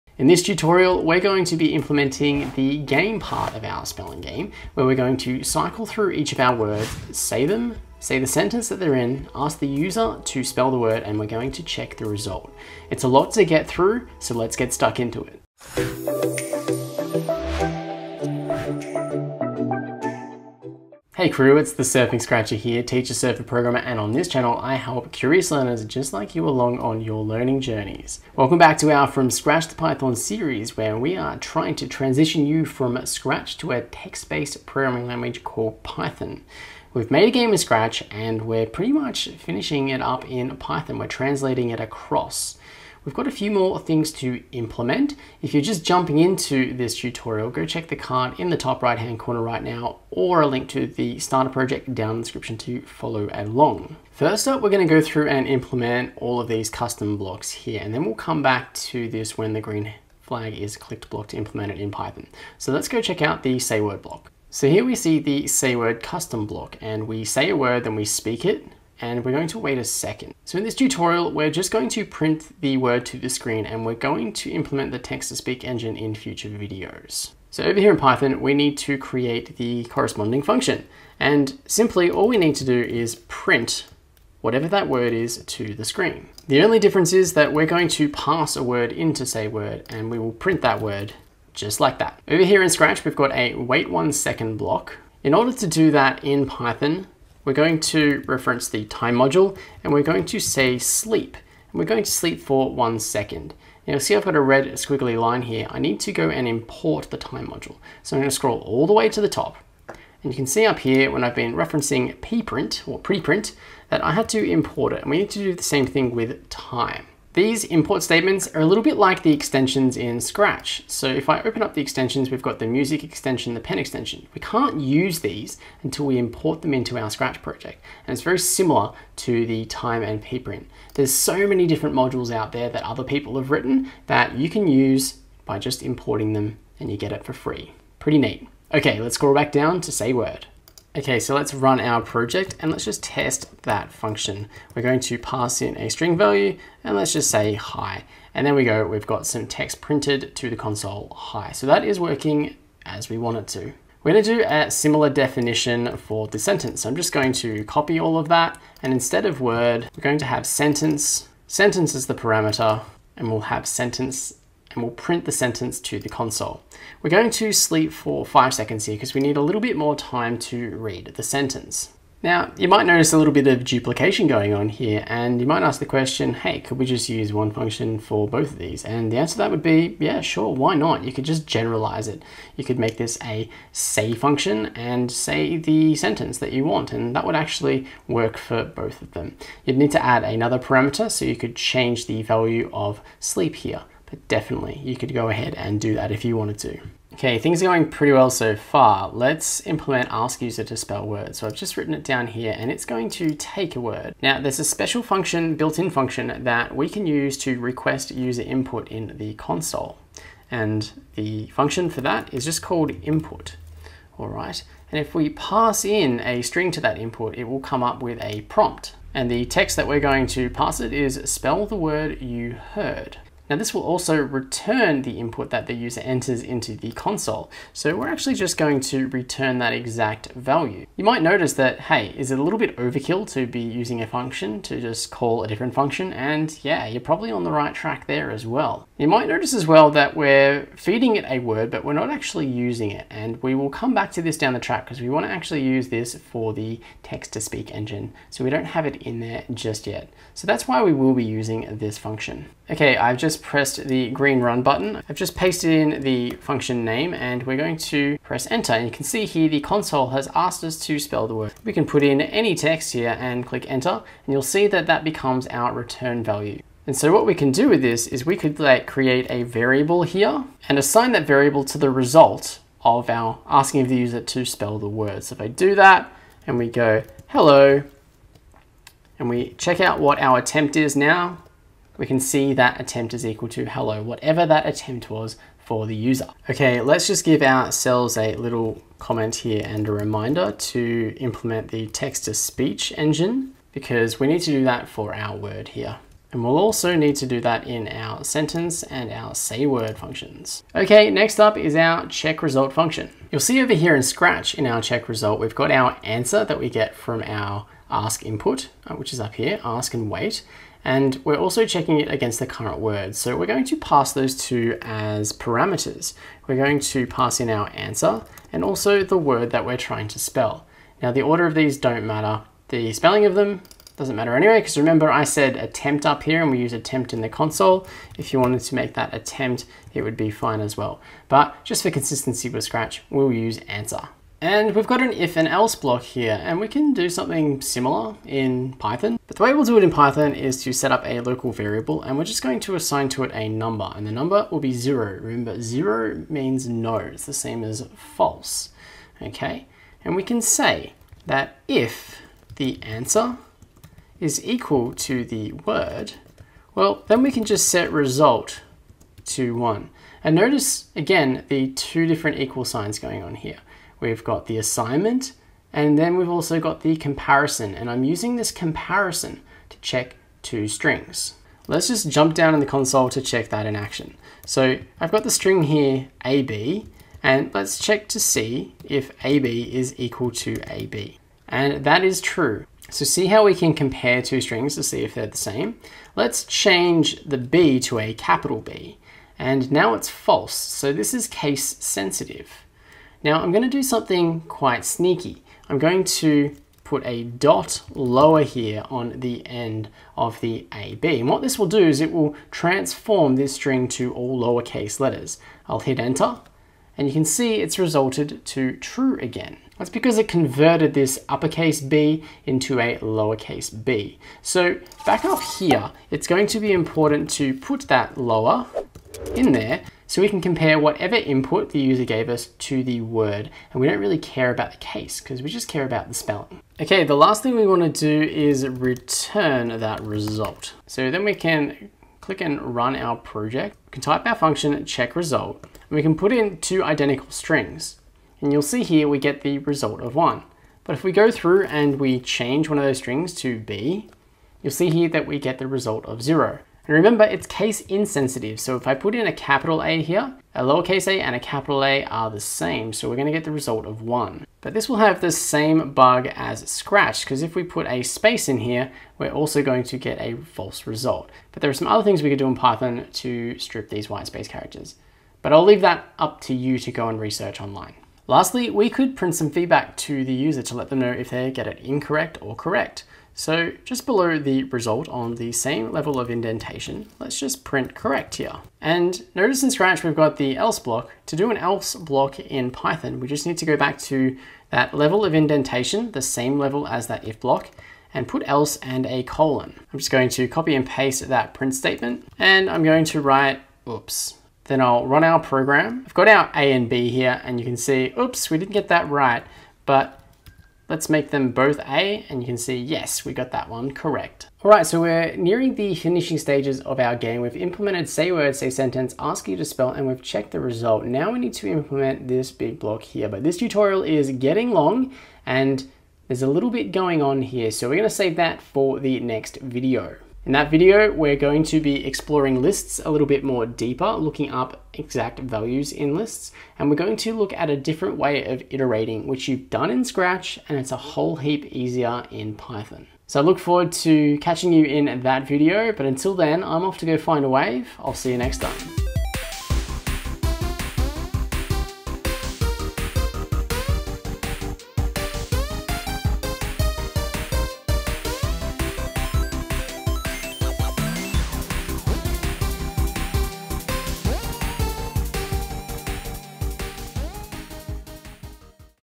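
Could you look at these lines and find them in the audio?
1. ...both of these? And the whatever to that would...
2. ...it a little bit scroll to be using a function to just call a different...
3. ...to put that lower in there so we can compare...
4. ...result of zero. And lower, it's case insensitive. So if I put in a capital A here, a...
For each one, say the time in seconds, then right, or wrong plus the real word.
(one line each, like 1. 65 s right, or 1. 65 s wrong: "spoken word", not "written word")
1. 178 s wrong: "answer", not "whatever"
2. 232 s wrong: "overkill", not "scroll"
3. 417 s right
4. 445 s wrong: "remember", not "lower".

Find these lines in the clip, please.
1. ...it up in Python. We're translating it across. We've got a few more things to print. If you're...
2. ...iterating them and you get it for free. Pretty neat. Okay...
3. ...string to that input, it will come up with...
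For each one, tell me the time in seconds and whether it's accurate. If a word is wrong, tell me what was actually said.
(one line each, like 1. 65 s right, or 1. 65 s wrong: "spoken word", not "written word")
1. 39 s wrong: "implement", not "print"
2. 135 s wrong: "importing", not "iterating"
3. 216 s right.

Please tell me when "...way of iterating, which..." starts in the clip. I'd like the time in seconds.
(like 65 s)
528 s.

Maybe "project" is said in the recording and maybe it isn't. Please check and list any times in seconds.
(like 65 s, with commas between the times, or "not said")
51 s, 127 s, 142 s, 433 s.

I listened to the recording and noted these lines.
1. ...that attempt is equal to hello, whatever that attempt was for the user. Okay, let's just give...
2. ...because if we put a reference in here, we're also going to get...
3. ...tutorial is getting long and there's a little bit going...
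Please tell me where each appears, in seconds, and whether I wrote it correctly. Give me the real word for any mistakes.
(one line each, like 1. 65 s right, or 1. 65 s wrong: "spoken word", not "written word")
1. 282 s right
2. 457 s wrong: "space", not "reference"
3. 513 s right.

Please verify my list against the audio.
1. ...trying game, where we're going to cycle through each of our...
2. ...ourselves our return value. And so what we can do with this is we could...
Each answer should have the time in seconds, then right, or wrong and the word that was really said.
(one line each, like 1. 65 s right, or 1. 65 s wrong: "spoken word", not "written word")
1. 3 s wrong: "spelling", not "trying"
2. 265 s wrong: "becomes", not "ourselves".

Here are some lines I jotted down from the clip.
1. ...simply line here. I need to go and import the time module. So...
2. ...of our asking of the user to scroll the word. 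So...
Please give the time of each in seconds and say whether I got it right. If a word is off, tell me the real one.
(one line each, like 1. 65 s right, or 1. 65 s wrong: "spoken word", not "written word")
1. 104 s wrong: "squiggly", not "simply"
2. 272 s wrong: "spell", not "scroll".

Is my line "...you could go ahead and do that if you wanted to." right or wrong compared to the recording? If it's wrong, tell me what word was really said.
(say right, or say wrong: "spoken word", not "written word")
right.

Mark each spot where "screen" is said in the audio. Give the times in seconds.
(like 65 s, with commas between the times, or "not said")
73 s, 85 s.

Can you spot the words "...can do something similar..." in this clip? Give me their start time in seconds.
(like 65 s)
336 s.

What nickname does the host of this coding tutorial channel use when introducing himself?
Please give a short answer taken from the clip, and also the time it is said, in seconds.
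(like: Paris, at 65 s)
Surfing Scratcher, at 21 s.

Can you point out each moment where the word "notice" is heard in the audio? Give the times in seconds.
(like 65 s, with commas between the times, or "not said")
172 s, 231 s, 239 s, 360 s, 479 s.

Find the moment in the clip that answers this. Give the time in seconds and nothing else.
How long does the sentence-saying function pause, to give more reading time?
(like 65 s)
168 s.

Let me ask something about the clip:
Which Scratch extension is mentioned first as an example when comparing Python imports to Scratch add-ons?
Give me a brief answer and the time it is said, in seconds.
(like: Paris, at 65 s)
music extension, at 122 s.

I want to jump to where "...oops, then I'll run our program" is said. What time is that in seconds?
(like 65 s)
493 s.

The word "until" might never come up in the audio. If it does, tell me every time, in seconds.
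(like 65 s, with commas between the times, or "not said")
125 s, 536 s.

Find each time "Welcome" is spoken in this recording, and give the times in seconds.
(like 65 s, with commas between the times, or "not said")
28 s.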